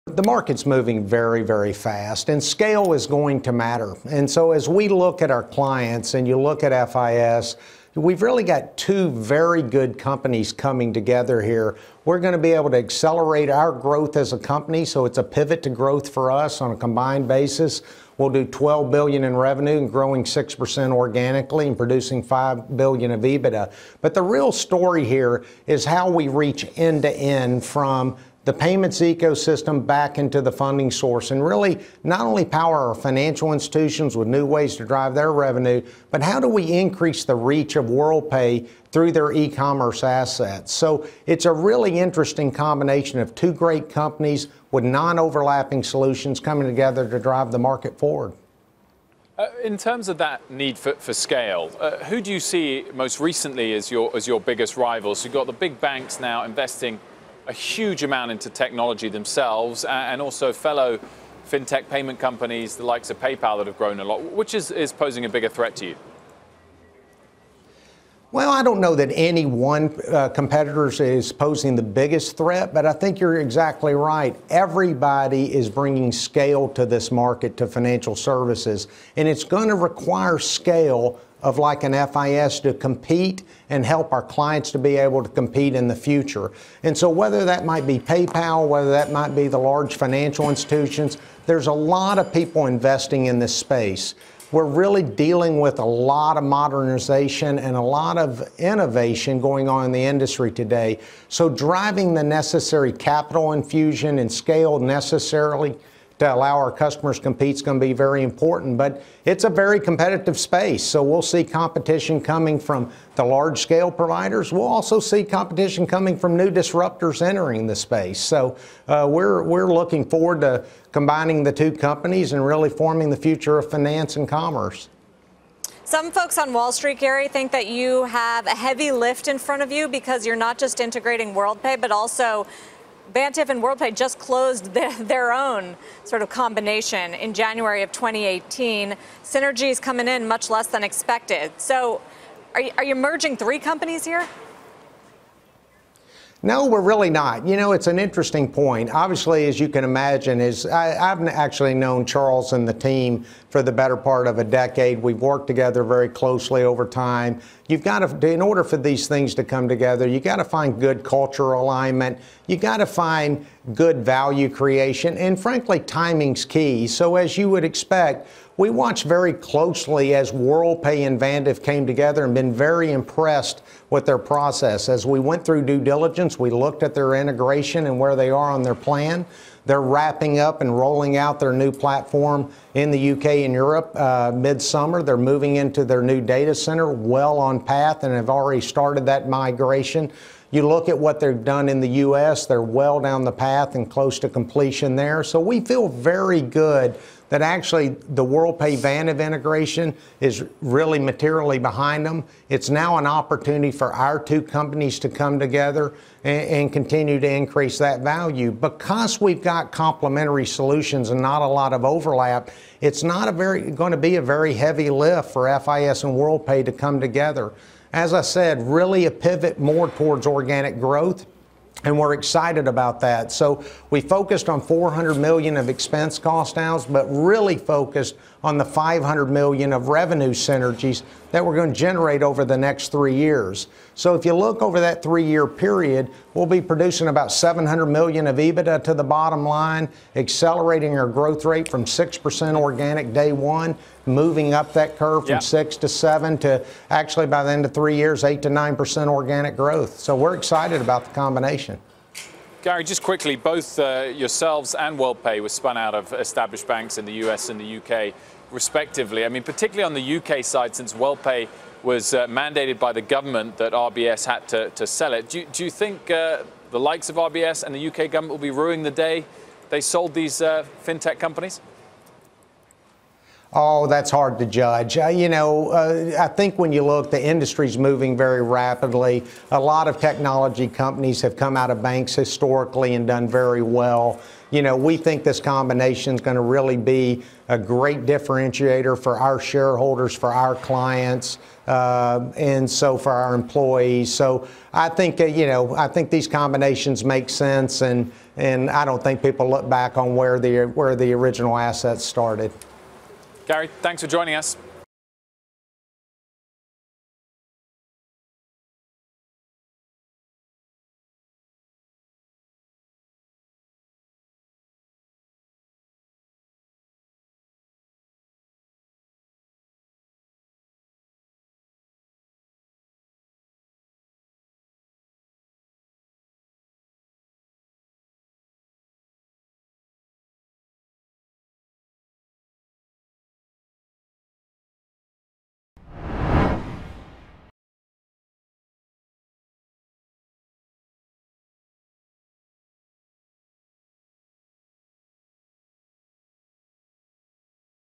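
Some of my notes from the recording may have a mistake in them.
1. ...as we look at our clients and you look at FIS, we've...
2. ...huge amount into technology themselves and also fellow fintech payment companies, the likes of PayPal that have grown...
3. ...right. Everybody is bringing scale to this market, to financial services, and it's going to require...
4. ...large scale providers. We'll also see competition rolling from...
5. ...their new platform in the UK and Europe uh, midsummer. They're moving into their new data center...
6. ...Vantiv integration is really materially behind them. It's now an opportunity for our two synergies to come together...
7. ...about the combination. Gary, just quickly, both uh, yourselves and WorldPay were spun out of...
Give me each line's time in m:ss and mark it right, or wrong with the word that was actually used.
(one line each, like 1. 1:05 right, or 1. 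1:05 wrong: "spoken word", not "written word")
1. 0:04 right
2. 0:57 right
3. 1:13 right
4. 1:53 wrong: "coming", not "rolling"
5. 3:01 right
6. 3:18 wrong: "companies", not "synergies"
7. 4:10 right.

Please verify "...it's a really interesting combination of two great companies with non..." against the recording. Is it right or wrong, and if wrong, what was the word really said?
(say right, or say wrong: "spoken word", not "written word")
right.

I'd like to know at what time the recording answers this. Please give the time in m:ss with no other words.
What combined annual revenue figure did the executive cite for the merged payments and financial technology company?
0:18.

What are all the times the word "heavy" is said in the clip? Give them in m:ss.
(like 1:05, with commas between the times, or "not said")
2:08, 3:34.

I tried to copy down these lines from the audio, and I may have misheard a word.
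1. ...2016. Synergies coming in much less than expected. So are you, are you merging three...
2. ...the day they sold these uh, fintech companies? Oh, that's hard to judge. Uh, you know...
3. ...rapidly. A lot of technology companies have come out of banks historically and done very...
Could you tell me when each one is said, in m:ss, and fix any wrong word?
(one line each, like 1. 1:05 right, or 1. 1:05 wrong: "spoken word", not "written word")
1. 2:17 wrong: "2018", not "2016"
2. 4:28 right
3. 4:38 right.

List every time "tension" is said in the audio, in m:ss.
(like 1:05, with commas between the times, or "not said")
not said.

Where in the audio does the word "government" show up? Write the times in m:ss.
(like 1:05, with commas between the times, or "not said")
4:23, 4:28.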